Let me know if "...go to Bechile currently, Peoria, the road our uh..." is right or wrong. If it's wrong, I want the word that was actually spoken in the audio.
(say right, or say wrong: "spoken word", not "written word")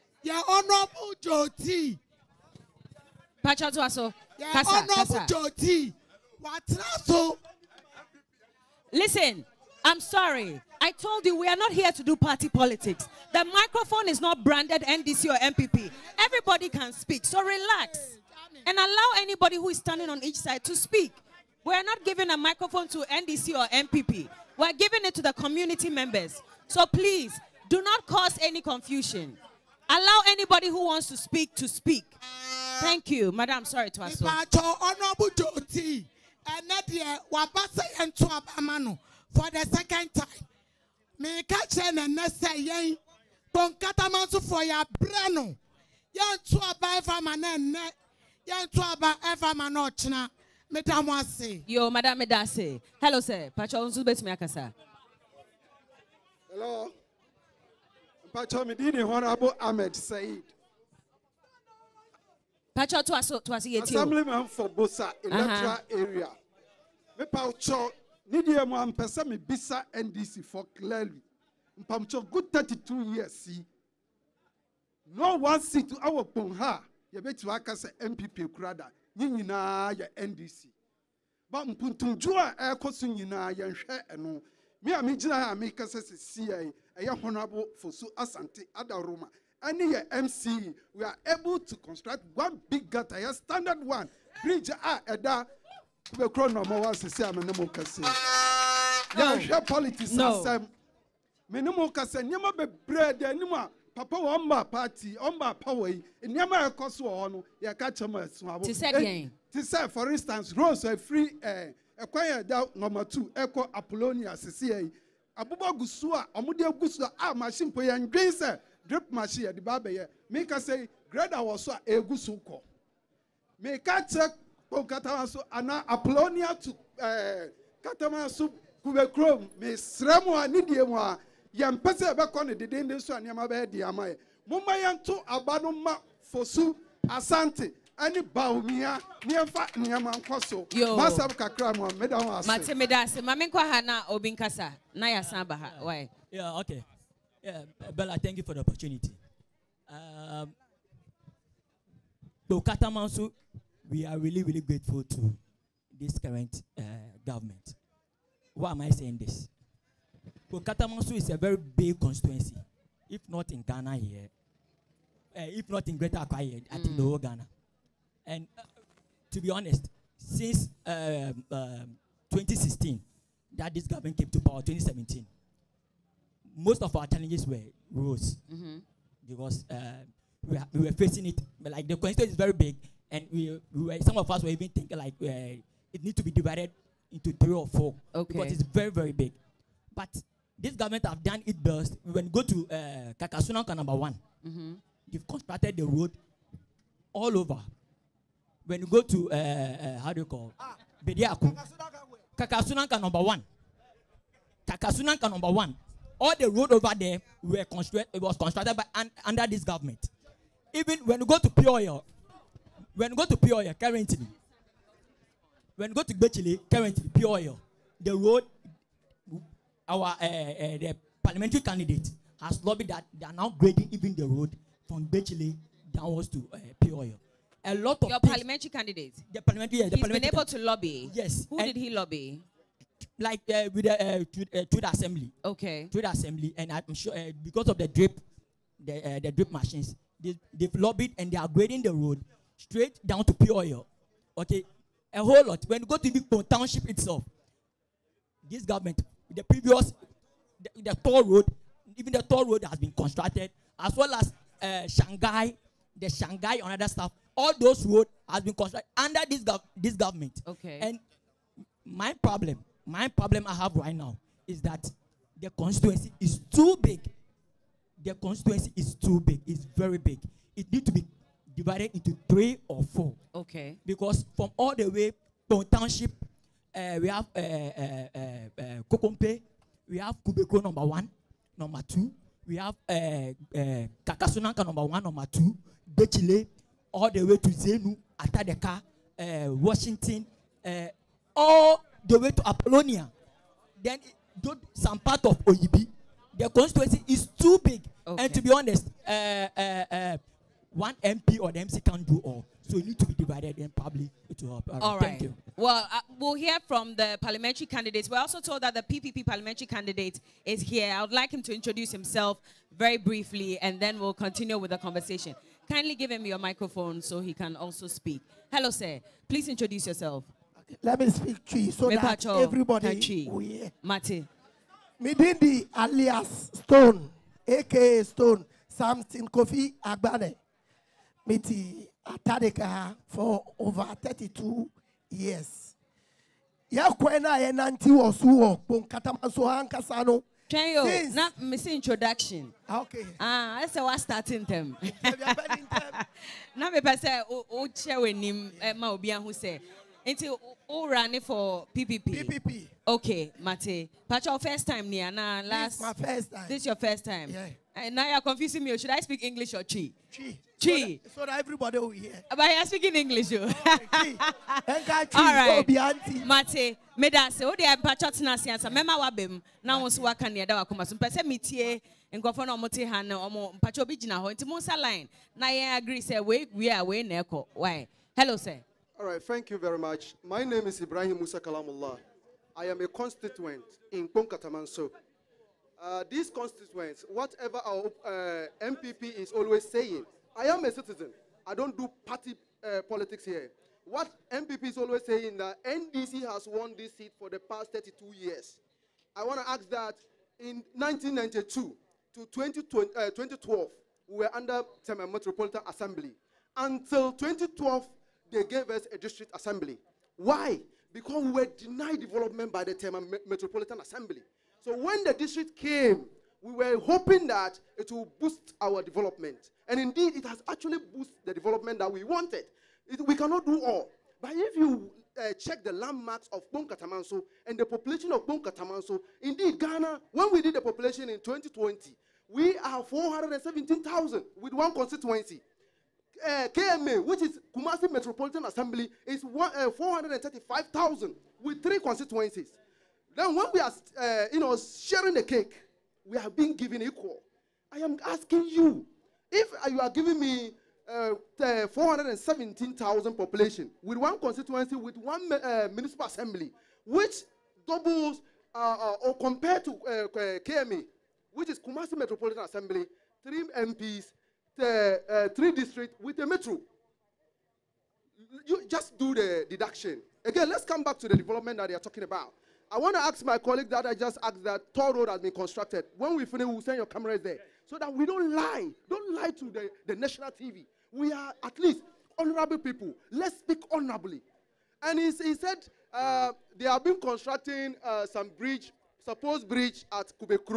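right.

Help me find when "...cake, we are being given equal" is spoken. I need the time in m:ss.
7:25.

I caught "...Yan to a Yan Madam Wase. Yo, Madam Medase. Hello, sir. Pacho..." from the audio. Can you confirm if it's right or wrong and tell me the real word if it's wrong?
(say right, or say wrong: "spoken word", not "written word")
right.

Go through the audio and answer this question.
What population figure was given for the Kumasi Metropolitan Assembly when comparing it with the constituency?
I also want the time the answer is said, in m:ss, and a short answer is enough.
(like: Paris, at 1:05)
435,000, at 7:19.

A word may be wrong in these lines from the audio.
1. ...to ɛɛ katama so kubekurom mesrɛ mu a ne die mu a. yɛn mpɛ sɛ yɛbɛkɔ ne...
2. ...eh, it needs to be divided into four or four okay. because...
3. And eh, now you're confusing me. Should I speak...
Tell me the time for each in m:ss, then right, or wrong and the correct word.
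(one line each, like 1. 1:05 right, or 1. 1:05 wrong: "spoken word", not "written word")
1. 2:06 right
2. 3:05 wrong: "three", not "four"
3. 5:57 right.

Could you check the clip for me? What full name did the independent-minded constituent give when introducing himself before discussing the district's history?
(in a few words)
Ibrahim Musa Kalamullah.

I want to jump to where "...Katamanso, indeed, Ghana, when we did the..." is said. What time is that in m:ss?
7:08.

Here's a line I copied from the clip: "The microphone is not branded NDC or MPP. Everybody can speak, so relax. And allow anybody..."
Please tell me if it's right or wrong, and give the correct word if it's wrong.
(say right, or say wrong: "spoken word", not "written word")
wrong: "NPP", not "MPP".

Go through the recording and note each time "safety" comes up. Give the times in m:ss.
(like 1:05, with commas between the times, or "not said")
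not said.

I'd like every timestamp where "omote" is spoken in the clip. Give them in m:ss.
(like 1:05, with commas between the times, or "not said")
6:12.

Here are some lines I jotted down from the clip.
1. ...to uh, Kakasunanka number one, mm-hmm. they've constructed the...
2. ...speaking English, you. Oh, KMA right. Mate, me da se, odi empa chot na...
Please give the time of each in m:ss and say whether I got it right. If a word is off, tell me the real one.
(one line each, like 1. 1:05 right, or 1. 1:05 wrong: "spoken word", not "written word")
1. 3:12 right
2. 6:02 wrong: "All", not "KMA".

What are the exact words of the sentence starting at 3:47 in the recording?
A lot of your parliamentary candidate.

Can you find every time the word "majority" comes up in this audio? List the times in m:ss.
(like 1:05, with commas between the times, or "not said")
not said.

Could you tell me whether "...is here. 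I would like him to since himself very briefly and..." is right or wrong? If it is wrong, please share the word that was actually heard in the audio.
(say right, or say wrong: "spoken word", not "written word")
wrong: "introduce", not "since".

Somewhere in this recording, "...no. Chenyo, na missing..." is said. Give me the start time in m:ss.
5:40.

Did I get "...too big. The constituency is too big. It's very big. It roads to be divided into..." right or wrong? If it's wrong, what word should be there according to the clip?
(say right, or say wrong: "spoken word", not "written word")
wrong: "needs", not "roads".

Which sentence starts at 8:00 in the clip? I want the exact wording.
We are at least honorable people.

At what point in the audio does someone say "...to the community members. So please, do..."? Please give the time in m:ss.
0:25.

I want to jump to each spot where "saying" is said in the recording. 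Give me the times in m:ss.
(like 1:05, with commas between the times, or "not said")
2:38, 6:29, 6:35.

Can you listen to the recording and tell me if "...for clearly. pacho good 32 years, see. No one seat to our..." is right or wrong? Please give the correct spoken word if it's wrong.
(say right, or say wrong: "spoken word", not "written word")
right.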